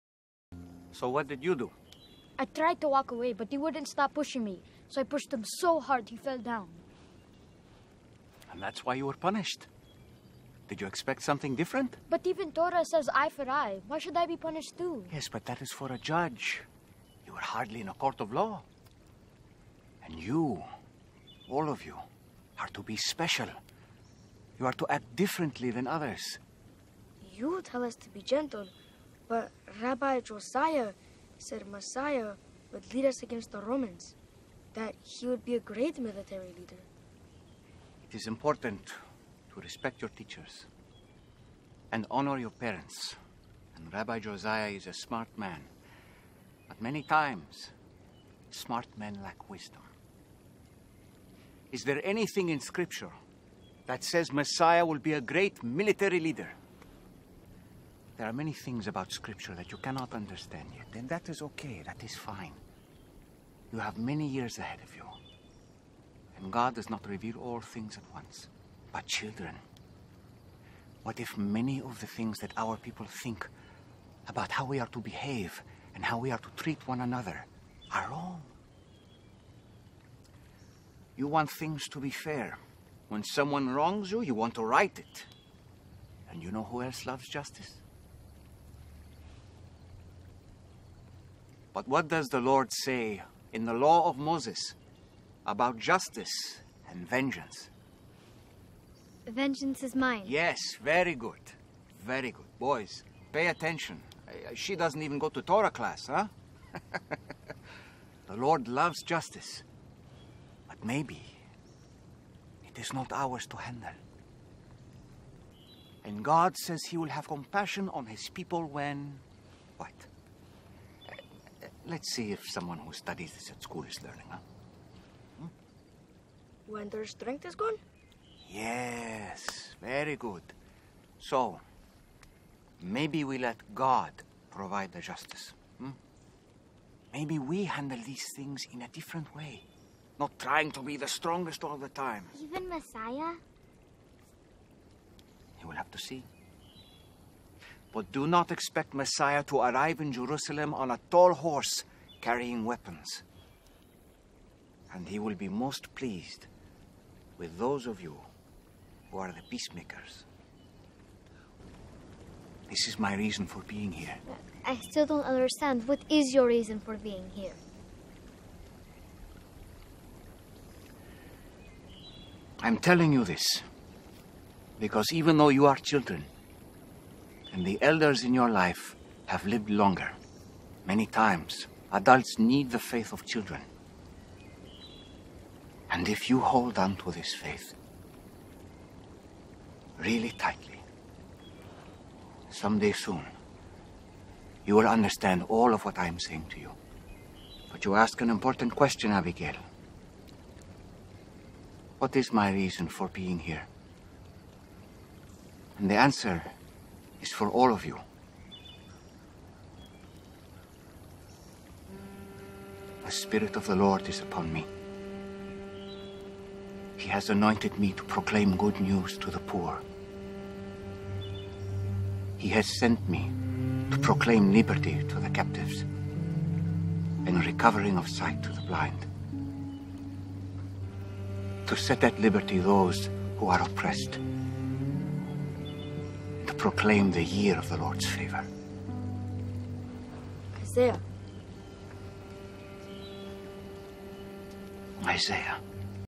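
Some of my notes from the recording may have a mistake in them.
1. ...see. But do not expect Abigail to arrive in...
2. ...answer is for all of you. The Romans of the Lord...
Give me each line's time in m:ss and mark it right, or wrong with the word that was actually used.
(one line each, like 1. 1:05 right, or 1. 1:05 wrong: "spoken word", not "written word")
1. 2:25 wrong: "Messiah", not "Abigail"
2. 3:25 wrong: "Spirit", not "Romans".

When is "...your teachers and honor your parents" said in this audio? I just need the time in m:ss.
0:40.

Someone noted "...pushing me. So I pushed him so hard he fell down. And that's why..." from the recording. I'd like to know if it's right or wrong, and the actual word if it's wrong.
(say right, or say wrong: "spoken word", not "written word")
right.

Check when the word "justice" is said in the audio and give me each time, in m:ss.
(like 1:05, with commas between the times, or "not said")
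1:27, 1:35, 1:49, 2:15.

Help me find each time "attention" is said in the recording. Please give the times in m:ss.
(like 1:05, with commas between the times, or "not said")
1:43.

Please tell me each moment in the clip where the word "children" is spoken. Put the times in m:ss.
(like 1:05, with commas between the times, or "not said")
1:09, 2:55, 3:03.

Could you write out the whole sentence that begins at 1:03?
You have many years ahead of you.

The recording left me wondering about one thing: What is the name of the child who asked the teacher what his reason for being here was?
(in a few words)
Abigail.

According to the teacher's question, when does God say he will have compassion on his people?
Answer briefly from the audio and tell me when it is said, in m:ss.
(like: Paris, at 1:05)
When their strength is gone, at 2:06.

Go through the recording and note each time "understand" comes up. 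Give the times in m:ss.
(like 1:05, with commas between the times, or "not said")
1:00, 2:45, 3:14.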